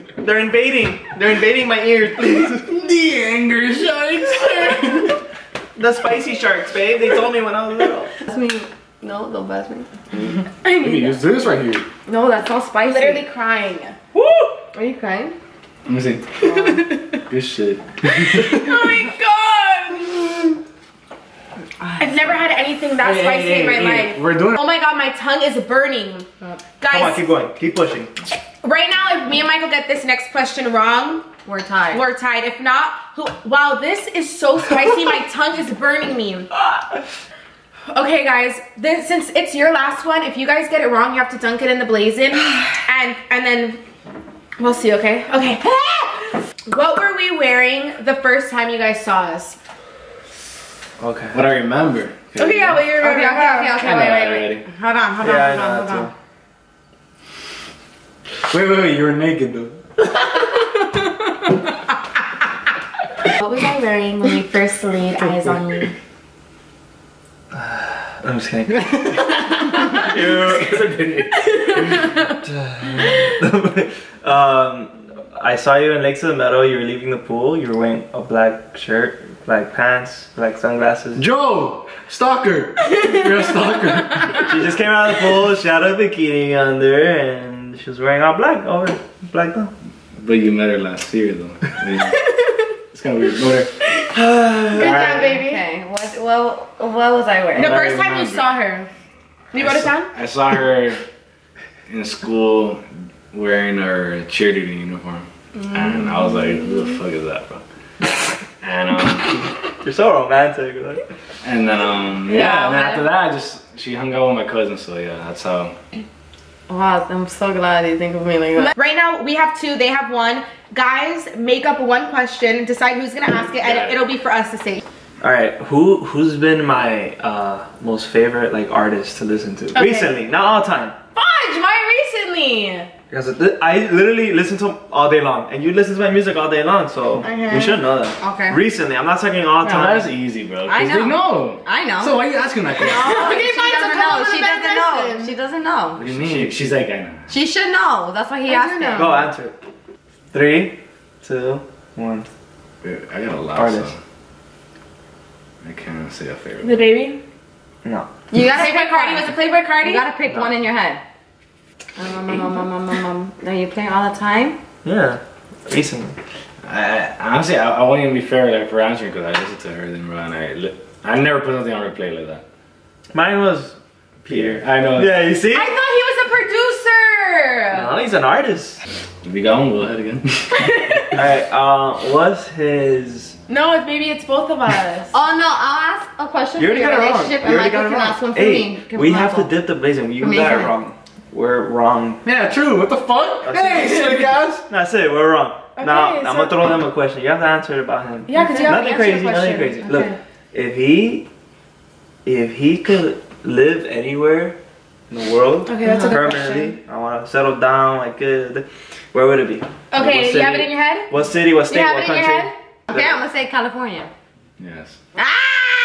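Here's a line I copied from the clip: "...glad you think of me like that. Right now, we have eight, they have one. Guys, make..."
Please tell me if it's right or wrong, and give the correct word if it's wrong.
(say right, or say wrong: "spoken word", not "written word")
wrong: "two", not "eight".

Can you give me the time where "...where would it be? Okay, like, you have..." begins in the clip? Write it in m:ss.
3:29.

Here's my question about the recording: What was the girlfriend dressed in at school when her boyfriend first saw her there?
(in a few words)
Cheerleading uniform.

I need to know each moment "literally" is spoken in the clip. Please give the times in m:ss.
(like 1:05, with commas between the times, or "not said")
0:12, 2:13.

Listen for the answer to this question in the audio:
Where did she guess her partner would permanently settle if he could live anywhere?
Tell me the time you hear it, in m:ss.
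3:33.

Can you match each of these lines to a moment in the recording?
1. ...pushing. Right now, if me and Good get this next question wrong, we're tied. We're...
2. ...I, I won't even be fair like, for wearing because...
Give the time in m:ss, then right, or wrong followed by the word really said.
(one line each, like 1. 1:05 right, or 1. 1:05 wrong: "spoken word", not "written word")
1. 0:27 wrong: "Michael", not "Good"
2. 2:47 wrong: "answering", not "wearing".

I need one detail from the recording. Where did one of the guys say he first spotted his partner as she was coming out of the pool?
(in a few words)
Lakes of the Meadow.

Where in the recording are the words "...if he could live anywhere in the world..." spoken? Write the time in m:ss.
3:22.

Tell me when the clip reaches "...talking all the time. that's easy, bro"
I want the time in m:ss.
2:19.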